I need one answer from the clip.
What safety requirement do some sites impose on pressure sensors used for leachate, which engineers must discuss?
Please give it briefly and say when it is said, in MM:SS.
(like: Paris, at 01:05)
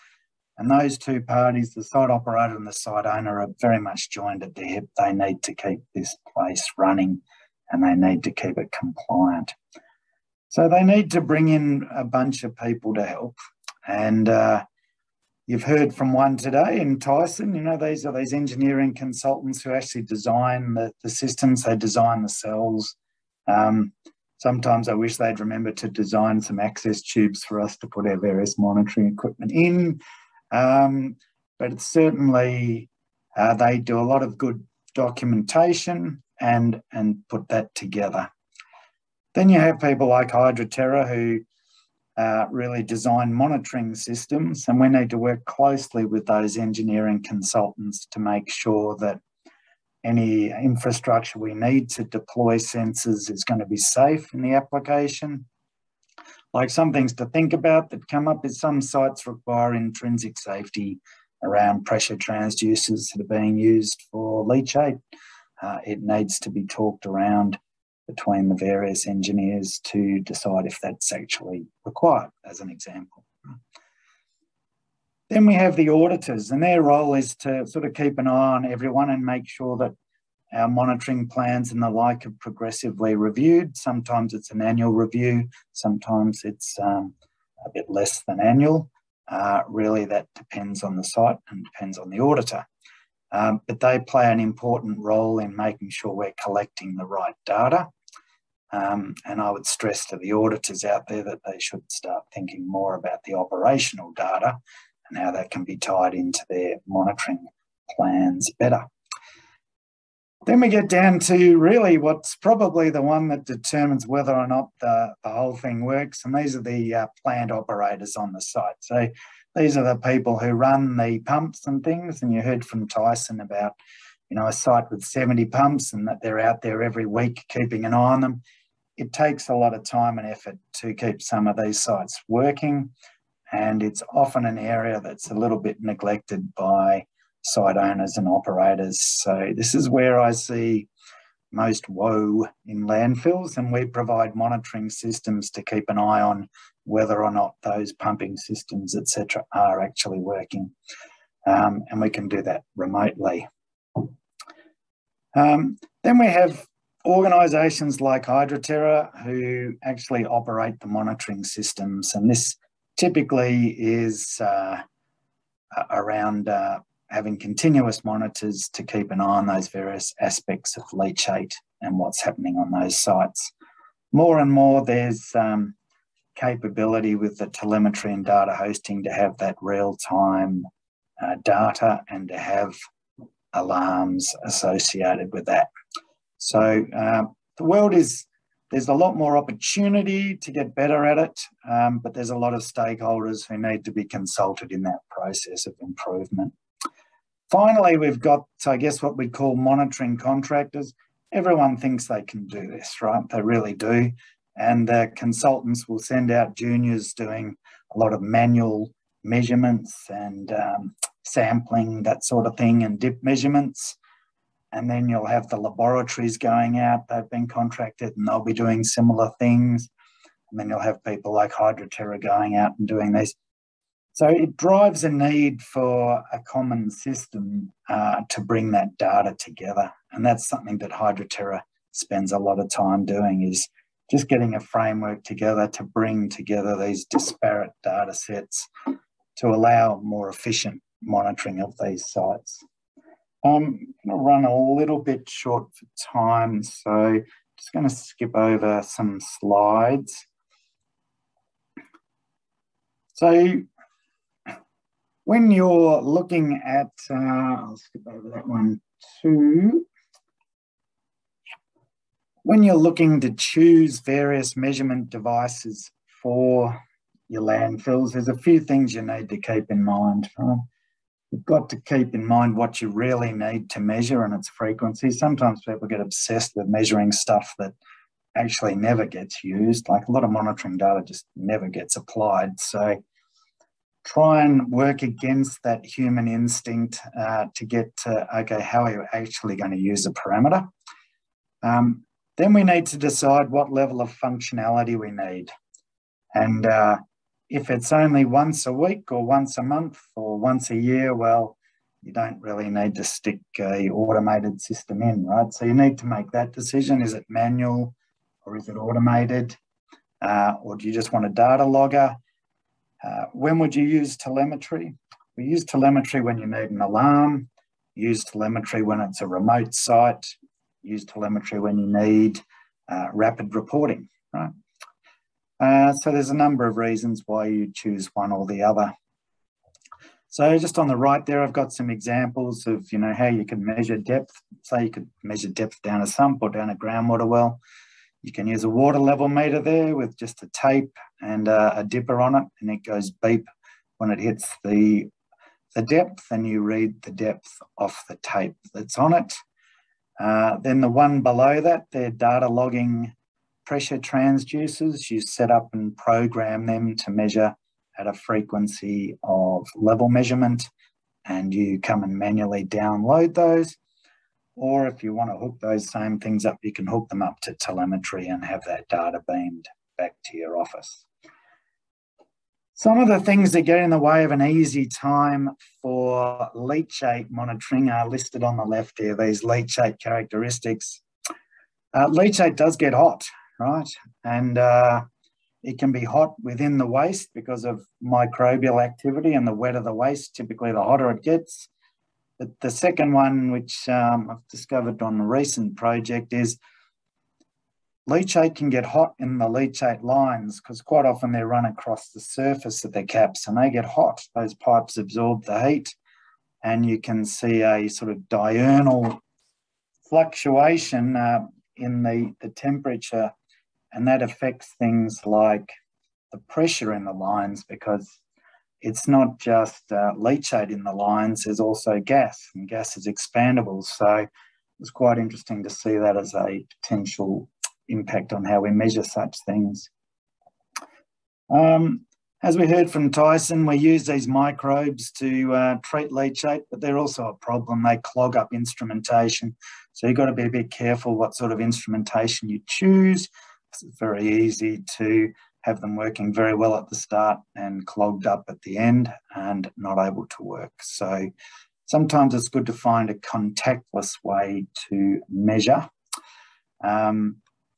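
Intrinsic safety, at 00:59.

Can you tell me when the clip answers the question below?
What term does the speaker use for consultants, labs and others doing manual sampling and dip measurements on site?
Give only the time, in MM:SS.
03:19.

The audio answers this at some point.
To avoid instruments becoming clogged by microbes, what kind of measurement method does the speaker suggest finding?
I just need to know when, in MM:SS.
07:33.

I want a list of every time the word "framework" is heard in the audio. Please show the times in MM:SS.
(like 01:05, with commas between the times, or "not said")
03:54.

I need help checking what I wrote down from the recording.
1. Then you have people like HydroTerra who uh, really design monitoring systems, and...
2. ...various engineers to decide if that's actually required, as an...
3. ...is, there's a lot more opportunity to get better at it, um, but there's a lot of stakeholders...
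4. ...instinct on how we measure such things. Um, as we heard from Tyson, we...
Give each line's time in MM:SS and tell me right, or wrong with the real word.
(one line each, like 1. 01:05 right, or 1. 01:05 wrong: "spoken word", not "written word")
1. 00:39 right
2. 01:08 right
3. 03:07 right
4. 07:07 wrong: "impact", not "instinct".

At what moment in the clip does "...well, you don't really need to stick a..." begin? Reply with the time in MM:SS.
05:01.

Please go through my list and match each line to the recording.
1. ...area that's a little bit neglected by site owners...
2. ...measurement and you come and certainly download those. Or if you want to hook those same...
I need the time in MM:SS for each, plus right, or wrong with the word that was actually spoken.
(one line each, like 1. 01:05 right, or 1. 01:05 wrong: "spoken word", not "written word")
1. 02:14 right
2. 06:00 wrong: "manually", not "certainly".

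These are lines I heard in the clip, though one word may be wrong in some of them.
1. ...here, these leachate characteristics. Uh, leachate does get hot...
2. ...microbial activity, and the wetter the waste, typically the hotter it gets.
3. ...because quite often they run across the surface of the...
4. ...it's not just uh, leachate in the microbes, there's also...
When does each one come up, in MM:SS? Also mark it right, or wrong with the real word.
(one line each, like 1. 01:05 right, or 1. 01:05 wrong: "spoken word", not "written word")
1. 06:18 right
2. 06:28 right
3. 06:40 right
4. 06:58 wrong: "lines", not "microbes".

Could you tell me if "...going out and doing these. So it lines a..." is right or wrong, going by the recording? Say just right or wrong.
wrong.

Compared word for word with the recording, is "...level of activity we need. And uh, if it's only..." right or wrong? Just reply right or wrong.
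wrong.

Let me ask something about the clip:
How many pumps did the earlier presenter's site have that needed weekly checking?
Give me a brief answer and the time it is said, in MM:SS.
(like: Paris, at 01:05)
70, at 02:05.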